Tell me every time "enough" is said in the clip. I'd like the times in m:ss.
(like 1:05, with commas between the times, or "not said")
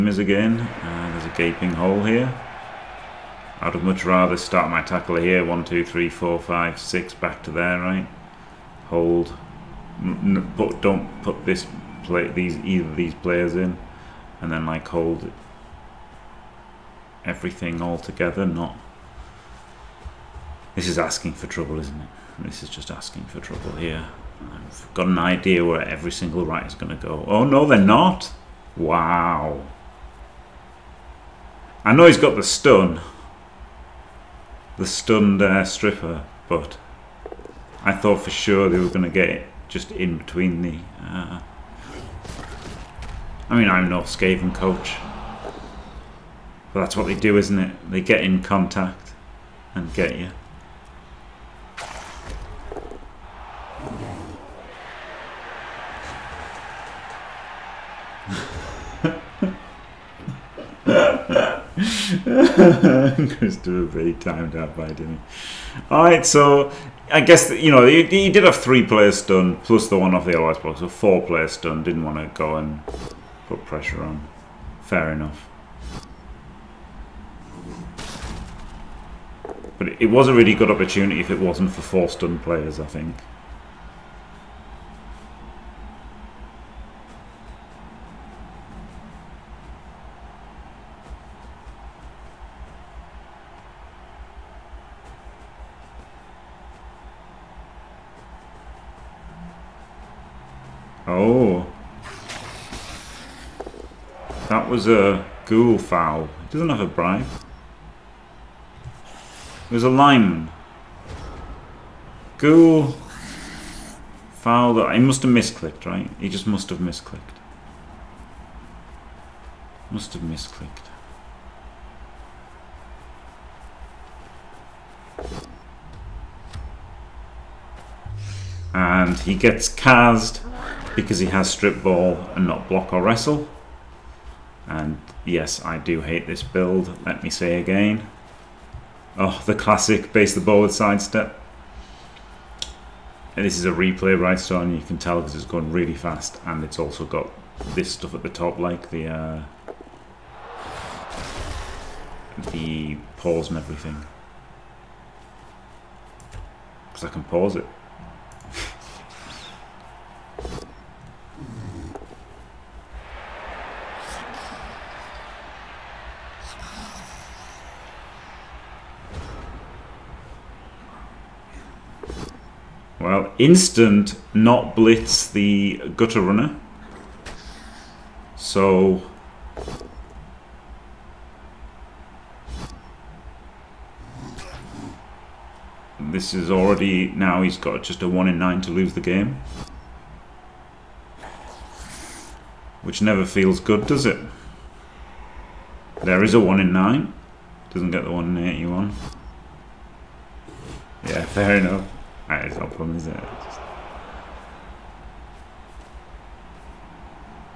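1:15, 3:21.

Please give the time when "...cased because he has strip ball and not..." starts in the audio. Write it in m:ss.
2:09.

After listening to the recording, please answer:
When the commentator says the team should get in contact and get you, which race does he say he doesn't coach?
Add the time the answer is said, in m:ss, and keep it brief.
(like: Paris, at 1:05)
Skaven, at 0:44.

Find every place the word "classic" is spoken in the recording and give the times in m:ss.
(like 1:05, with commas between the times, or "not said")
2:19.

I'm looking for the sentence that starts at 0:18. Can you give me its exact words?
Not this is asking for trouble, isn't it?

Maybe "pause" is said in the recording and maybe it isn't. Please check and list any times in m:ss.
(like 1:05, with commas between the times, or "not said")
2:33, 2:37.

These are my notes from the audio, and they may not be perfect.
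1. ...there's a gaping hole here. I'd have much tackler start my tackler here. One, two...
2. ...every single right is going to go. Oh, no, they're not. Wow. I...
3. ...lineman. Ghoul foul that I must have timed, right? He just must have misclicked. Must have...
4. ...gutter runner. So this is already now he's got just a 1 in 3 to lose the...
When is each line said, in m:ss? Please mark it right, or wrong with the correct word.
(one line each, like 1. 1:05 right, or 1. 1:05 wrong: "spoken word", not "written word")
1. 0:01 wrong: "rather", not "tackler"
2. 0:25 right
3. 1:49 wrong: "misclicked", not "timed"
4. 2:55 wrong: "9", not "3".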